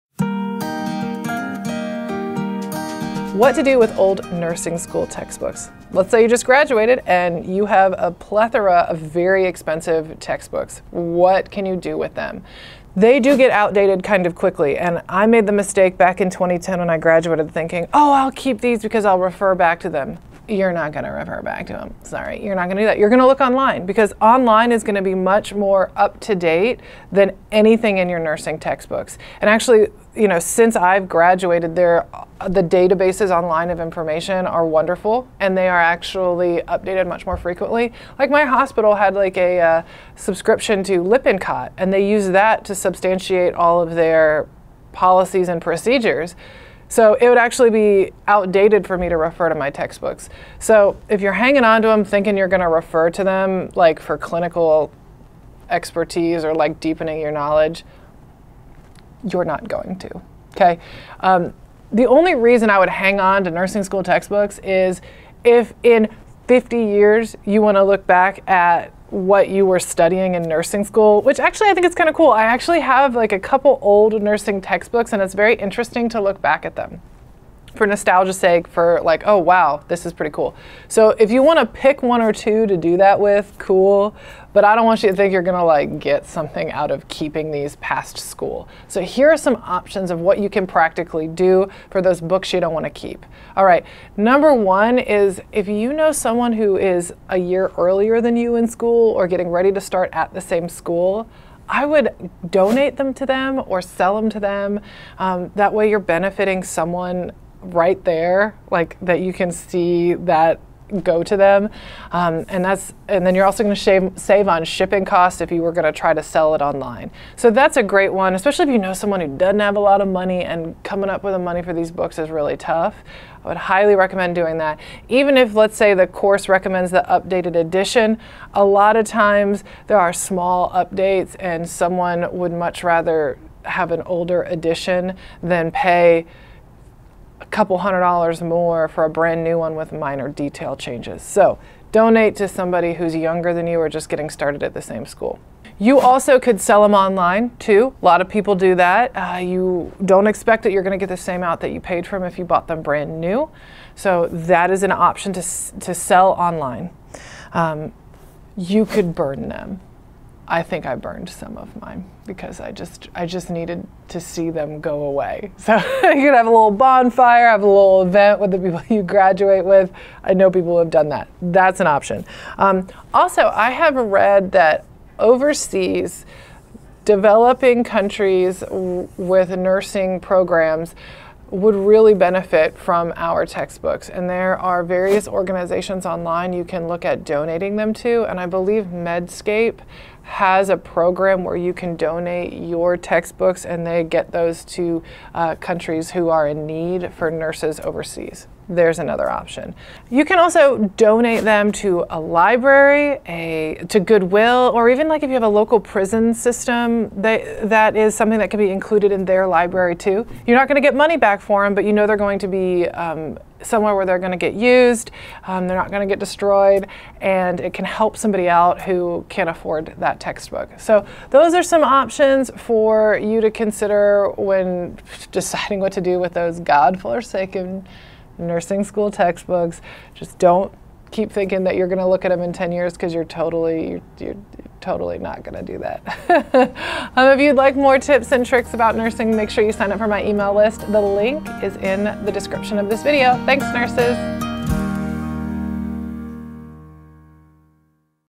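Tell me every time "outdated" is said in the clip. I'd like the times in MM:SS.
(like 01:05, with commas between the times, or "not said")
00:13, 00:48.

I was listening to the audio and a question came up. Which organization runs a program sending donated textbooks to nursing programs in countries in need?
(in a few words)
Medscape.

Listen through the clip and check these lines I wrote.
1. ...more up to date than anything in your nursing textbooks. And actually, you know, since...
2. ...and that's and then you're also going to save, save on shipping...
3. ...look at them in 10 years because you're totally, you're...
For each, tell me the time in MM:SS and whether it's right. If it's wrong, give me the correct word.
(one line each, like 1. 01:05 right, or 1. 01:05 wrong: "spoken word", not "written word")
1. 00:25 right
2. 01:52 right
3. 03:52 right.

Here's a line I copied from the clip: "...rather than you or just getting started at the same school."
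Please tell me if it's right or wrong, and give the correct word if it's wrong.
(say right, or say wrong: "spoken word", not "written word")
wrong: "younger", not "rather".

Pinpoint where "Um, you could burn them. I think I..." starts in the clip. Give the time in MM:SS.
02:37.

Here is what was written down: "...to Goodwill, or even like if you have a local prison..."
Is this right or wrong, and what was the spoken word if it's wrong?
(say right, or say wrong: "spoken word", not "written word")
right.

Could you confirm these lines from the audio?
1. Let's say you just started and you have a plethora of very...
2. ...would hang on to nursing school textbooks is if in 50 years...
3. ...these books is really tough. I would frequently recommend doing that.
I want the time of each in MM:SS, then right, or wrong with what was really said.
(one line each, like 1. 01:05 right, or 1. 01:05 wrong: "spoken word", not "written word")
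1. 00:05 wrong: "graduated", not "started"
2. 01:02 right
3. 02:01 wrong: "highly", not "frequently".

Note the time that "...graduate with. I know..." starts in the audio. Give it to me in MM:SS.
02:49.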